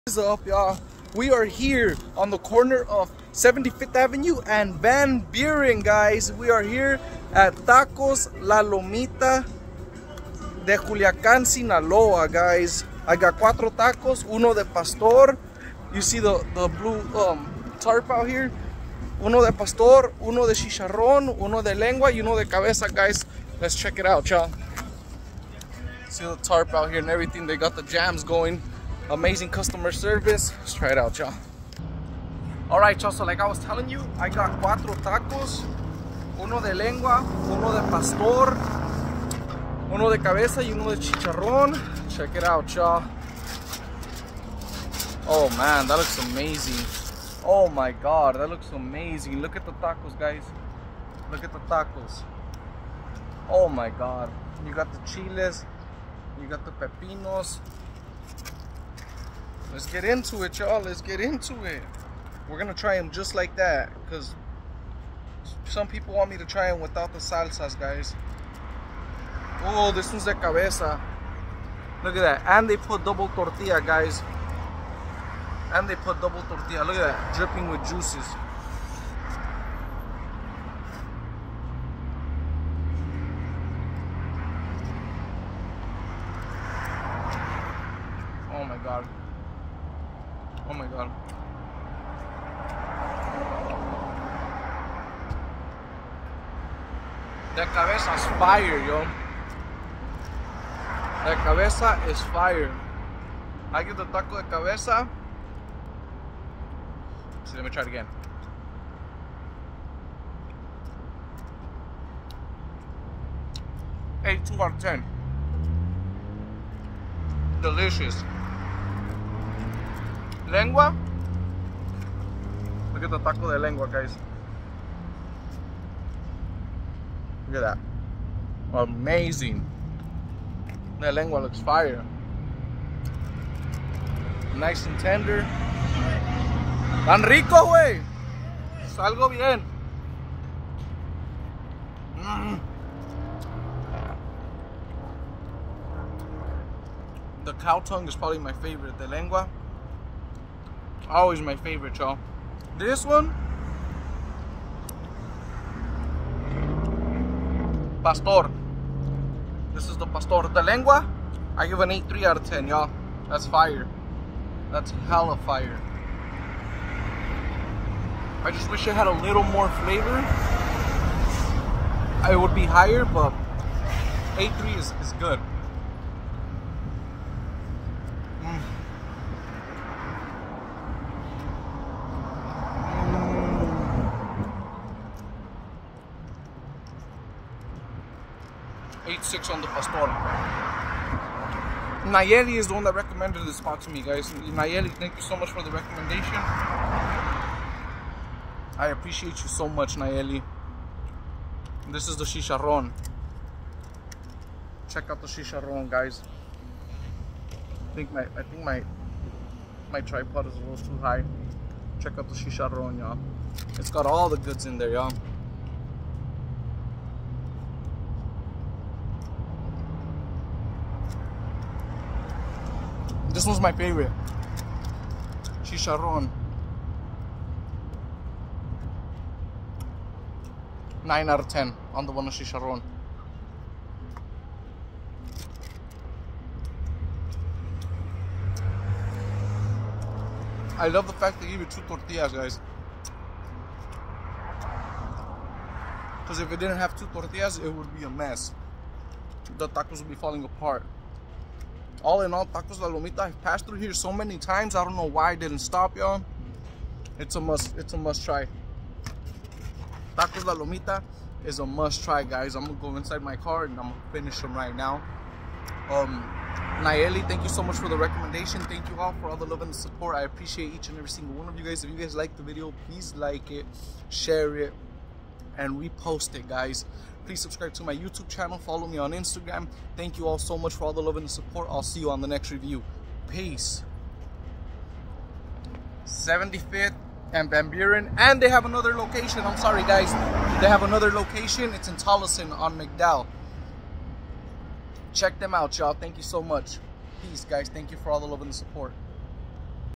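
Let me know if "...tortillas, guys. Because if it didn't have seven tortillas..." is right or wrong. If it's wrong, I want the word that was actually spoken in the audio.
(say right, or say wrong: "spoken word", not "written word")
wrong: "two", not "seven".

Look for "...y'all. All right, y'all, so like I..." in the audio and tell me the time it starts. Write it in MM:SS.
00:31.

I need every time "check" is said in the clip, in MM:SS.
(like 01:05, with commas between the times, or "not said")
00:23, 00:42, 03:24, 03:31, 04:55.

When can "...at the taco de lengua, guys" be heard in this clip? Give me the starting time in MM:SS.
02:03.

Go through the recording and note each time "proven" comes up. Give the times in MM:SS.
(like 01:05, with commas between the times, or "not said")
not said.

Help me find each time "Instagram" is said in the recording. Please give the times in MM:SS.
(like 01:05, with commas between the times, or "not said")
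04:39.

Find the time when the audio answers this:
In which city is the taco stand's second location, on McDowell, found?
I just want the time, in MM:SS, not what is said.
04:51.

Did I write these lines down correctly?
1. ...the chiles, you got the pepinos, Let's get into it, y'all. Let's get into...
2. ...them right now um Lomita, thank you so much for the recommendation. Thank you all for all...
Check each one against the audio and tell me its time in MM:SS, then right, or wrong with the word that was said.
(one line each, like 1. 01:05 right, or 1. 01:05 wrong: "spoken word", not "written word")
1. 00:54 right
2. 04:24 wrong: "Nayeli", not "Lomita".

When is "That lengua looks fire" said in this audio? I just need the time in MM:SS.
02:10.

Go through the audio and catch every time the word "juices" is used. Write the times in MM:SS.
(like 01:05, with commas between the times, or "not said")
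01:17.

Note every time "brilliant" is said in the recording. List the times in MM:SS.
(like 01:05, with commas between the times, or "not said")
not said.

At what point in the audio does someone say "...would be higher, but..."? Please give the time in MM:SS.
02:52.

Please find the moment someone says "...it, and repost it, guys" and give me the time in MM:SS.
04:34.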